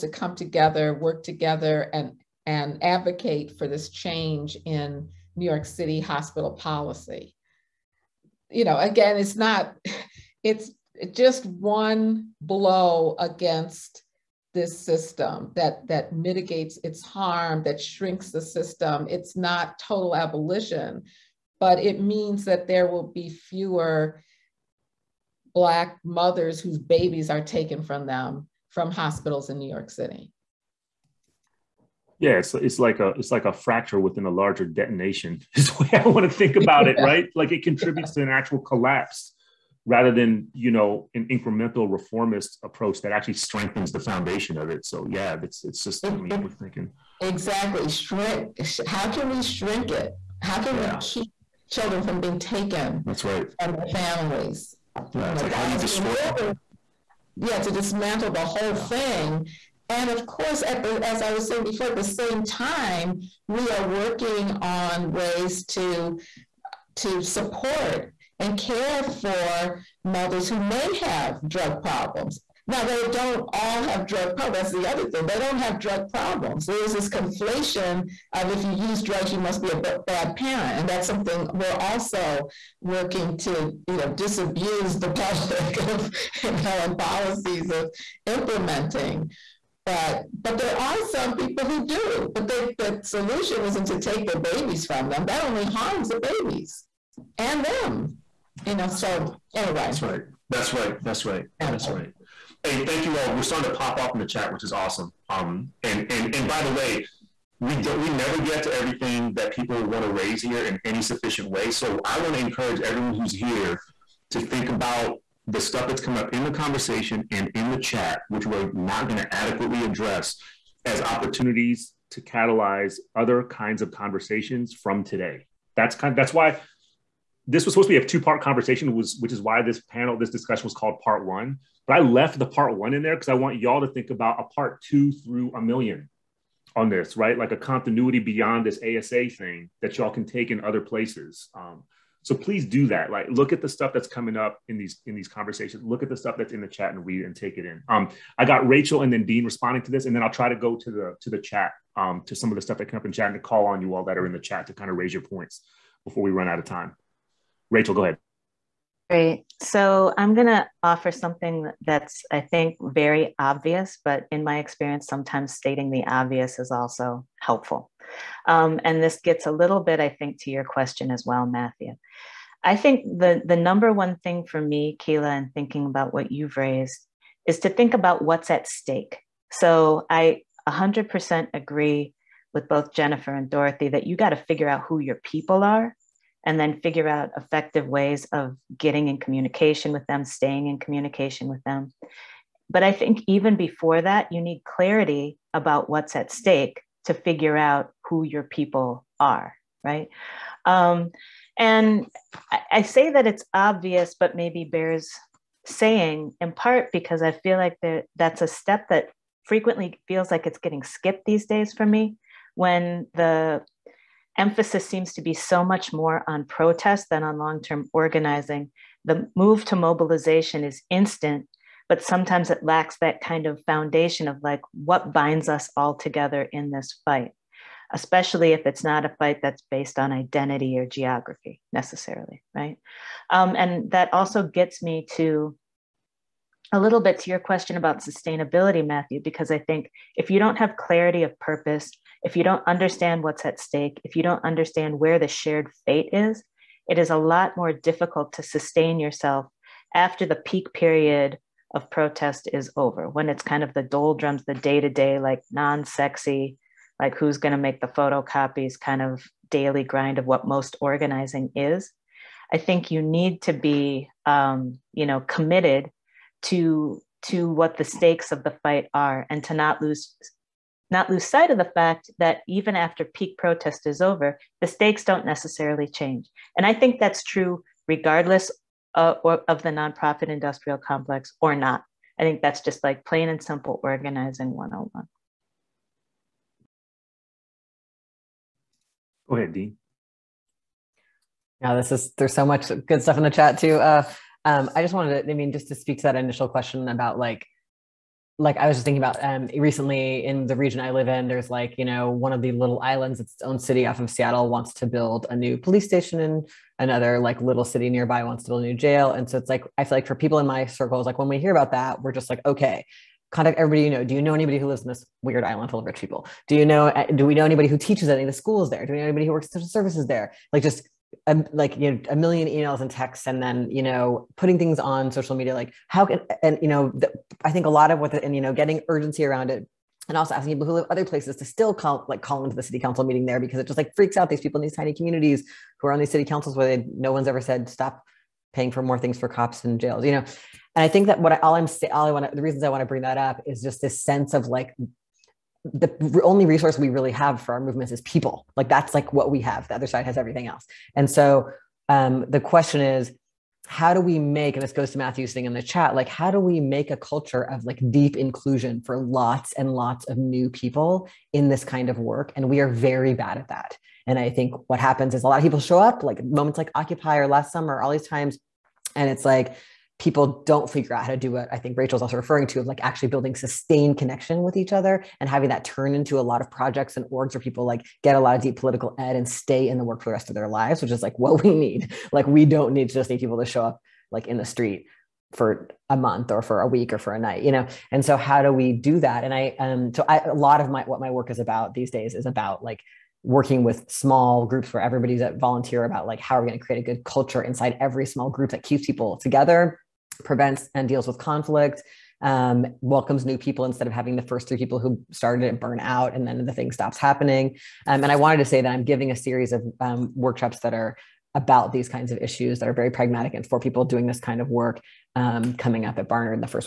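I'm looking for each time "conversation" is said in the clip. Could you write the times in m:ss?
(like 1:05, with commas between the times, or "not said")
1:56, 2:03, 2:08, 2:25.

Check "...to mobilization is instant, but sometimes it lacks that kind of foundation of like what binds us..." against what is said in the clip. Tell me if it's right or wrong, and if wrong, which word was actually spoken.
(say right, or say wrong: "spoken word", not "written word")
right.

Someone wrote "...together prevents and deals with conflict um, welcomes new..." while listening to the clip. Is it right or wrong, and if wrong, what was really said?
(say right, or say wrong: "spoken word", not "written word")
right.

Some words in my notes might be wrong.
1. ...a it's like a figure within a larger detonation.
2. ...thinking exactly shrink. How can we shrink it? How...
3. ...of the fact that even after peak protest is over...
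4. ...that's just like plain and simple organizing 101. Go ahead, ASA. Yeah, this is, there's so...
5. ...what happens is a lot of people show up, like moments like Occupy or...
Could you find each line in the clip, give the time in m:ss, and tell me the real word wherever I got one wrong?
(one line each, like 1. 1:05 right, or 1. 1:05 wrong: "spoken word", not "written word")
1. 0:32 wrong: "fracture", not "figure"
2. 0:46 right
3. 4:31 right
4. 4:42 wrong: "Dean", not "ASA"
5. 6:04 right.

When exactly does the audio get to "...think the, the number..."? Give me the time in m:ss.
2:52.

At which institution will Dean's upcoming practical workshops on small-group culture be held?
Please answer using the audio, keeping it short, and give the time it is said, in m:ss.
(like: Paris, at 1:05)
Barnard, at 6:56.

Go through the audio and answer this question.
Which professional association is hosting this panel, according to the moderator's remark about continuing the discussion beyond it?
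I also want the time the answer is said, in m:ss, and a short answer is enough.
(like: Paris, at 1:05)
ASA, at 2:18.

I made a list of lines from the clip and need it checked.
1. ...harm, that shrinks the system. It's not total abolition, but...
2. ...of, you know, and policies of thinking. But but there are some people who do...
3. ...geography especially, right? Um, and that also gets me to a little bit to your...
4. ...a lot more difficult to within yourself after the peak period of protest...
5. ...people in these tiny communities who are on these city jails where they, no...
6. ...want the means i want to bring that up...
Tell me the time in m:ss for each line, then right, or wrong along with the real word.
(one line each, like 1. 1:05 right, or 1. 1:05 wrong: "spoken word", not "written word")
1. 0:17 right
2. 1:25 wrong: "implementing", not "thinking"
3. 3:50 wrong: "necessarily", not "especially"
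4. 4:07 wrong: "sustain", not "within"
5. 5:34 wrong: "councils", not "jails"
6. 5:42 wrong: "reasons", not "means".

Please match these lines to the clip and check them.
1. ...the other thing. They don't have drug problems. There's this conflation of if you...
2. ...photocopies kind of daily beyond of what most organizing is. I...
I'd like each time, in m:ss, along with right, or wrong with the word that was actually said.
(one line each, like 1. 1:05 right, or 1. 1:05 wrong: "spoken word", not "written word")
1. 1:14 right
2. 4:17 wrong: "grind", not "beyond".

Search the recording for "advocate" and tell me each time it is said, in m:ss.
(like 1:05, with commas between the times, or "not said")
0:02.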